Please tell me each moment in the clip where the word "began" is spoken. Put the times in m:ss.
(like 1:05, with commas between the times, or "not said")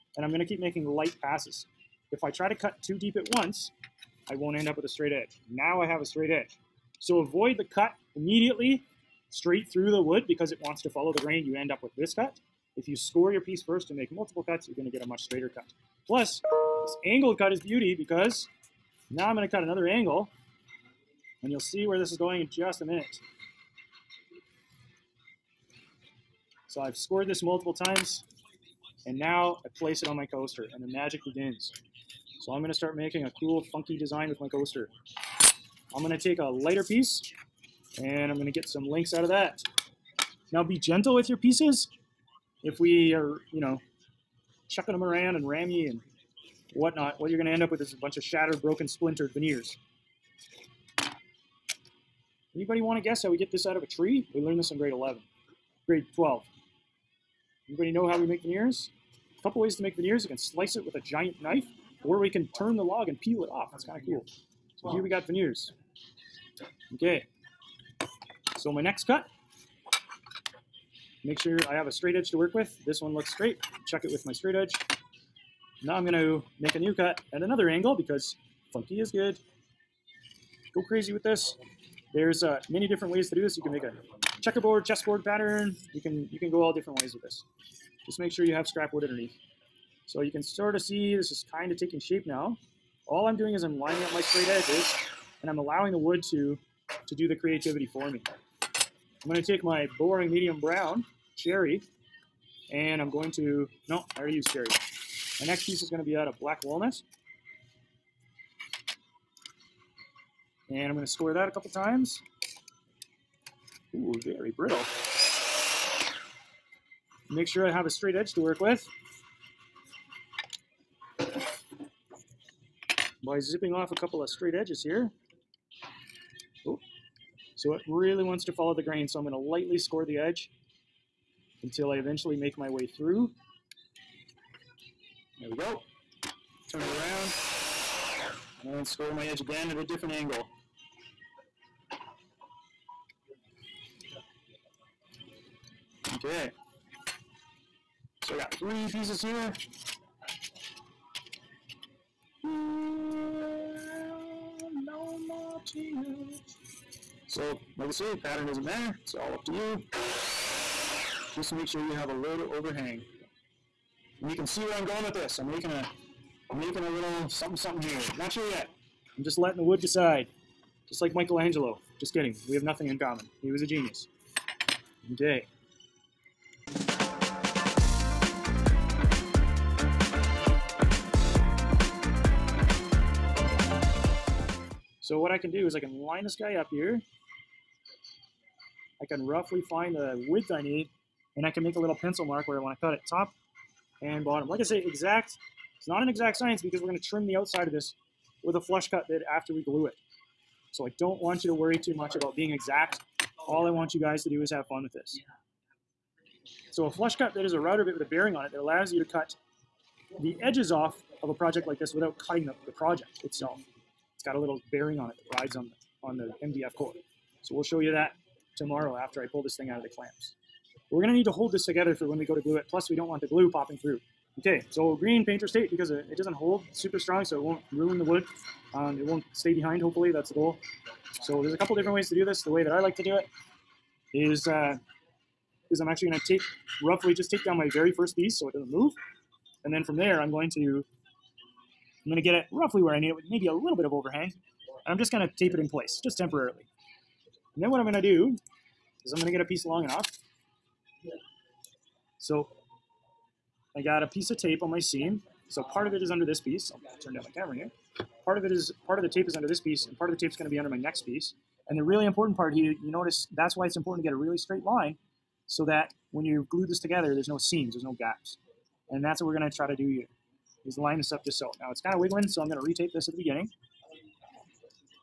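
not said.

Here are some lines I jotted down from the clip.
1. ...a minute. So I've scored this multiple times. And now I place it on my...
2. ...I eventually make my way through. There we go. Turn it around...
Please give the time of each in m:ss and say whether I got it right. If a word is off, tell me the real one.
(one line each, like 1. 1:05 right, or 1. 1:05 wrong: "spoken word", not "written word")
1. 0:22 right
2. 2:11 right.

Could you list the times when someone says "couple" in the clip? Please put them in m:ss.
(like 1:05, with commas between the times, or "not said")
0:59, 1:51, 2:03, 3:51.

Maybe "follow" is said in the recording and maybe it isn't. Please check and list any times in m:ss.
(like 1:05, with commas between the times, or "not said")
0:10, 2:08.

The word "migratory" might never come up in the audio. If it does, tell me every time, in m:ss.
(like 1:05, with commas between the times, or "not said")
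not said.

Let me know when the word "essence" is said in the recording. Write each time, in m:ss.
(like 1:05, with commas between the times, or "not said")
not said.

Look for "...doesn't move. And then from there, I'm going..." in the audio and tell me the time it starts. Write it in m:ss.
3:58.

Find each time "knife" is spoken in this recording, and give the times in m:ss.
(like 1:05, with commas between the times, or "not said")
1:01.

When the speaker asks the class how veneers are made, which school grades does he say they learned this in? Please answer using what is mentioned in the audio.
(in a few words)
grade 11, grade 12.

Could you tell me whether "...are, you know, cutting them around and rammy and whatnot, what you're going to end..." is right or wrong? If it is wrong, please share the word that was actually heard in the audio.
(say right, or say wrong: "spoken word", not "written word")
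wrong: "chucking", not "cutting".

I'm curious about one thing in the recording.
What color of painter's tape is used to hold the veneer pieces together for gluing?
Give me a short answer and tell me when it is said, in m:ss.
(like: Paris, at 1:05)
green, at 3:44.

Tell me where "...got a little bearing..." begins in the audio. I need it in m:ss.
3:34.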